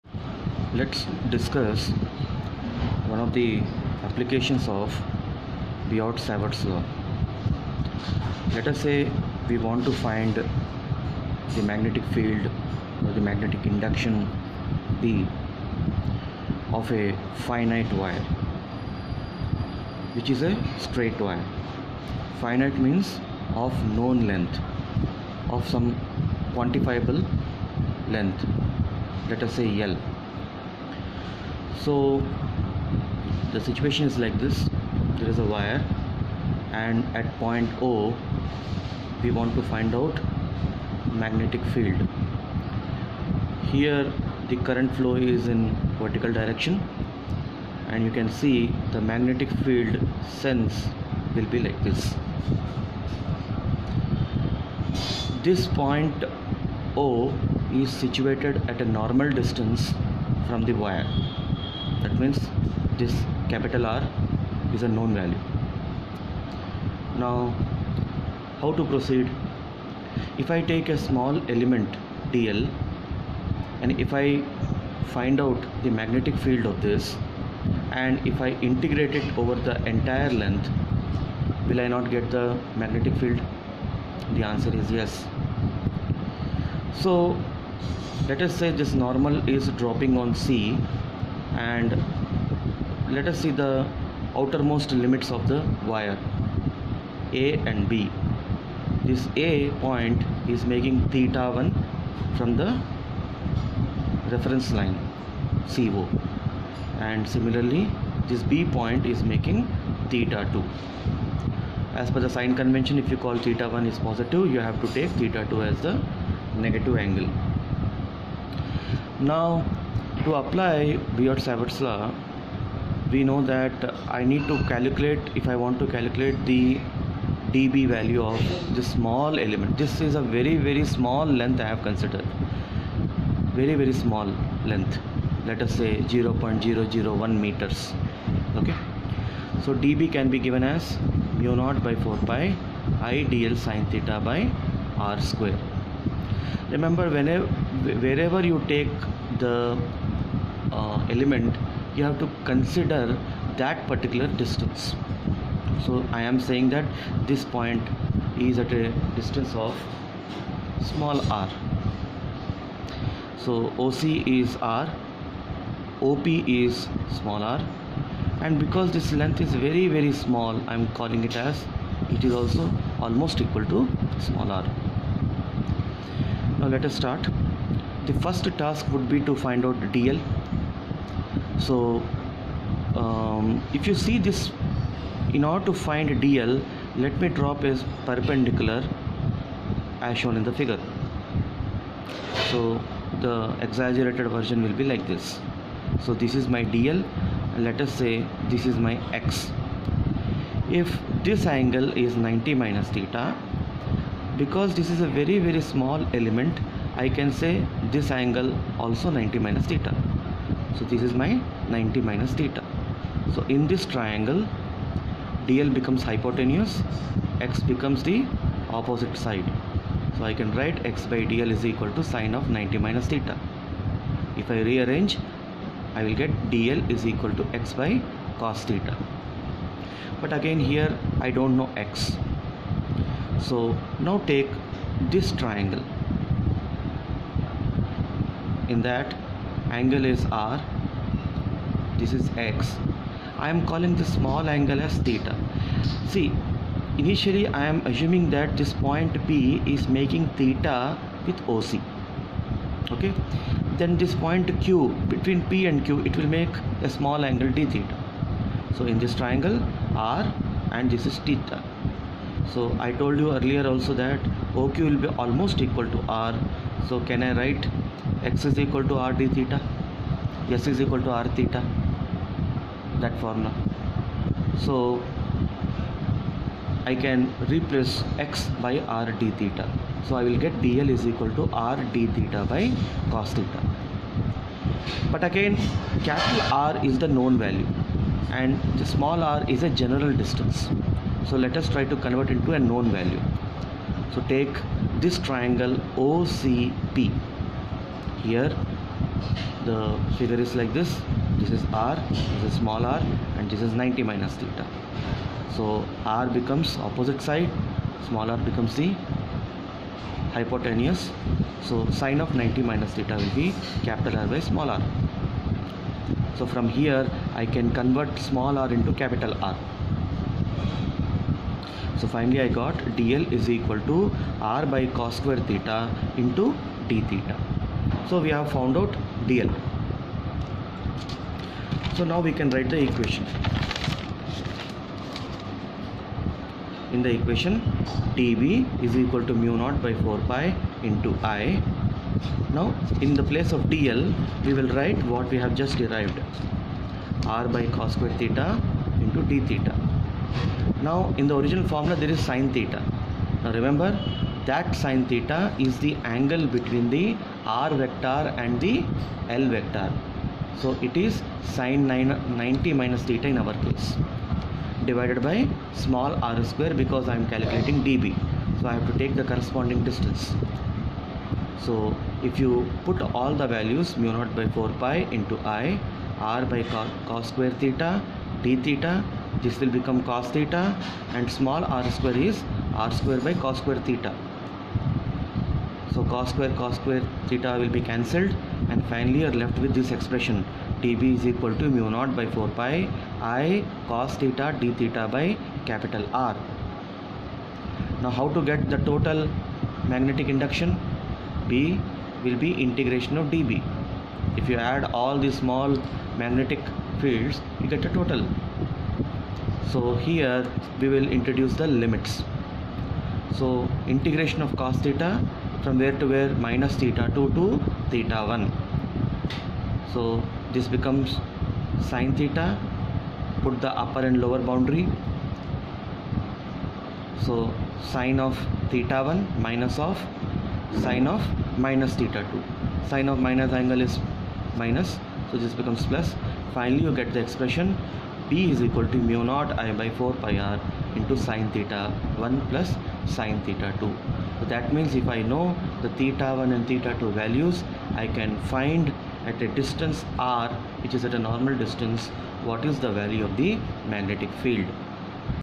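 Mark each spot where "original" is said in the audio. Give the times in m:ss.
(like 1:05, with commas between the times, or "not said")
5:51.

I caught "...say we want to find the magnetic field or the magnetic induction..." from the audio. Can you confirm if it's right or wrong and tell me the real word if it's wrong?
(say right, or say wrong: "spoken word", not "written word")
right.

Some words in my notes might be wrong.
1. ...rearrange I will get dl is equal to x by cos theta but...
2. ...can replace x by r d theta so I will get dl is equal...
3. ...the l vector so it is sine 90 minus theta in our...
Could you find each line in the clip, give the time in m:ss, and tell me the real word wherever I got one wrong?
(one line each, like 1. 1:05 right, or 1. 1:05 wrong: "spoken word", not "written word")
1. 3:44 right
2. 4:37 right
3. 5:58 right.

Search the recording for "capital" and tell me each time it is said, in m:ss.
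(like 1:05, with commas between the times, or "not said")
1:03, 4:46, 5:13, 5:19, 6:35.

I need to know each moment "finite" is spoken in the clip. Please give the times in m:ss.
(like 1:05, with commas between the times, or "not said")
0:17, 0:22.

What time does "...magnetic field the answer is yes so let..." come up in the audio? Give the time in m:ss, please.
1:22.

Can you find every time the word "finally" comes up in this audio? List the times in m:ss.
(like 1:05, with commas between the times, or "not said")
5:22, 6:28, 7:16.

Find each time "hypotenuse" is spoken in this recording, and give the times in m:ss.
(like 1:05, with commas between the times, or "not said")
3:36, 5:10.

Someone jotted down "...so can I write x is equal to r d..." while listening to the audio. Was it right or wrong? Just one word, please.
right.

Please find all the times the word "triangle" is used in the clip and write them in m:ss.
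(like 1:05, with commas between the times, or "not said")
3:33, 3:55, 4:19, 4:55.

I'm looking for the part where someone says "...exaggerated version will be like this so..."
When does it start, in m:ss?
3:13.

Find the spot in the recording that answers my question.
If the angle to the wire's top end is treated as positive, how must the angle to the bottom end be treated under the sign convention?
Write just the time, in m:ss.
1:56.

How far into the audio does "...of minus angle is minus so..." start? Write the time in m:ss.
7:13.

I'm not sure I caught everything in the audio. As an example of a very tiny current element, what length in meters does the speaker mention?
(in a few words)
0.001 meters.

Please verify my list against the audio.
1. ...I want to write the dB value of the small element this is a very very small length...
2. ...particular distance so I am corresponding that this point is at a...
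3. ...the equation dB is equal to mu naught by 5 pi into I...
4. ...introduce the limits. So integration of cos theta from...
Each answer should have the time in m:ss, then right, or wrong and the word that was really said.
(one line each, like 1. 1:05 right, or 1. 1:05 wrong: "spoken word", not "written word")
1. 2:05 wrong: "calculate", not "write"
2. 2:33 wrong: "saying", not "corresponding"
3. 5:37 wrong: "4", not "5"
4. 6:51 right.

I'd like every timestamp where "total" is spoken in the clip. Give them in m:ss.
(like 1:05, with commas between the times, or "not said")
6:38, 6:47.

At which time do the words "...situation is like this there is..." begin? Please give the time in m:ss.
0:33.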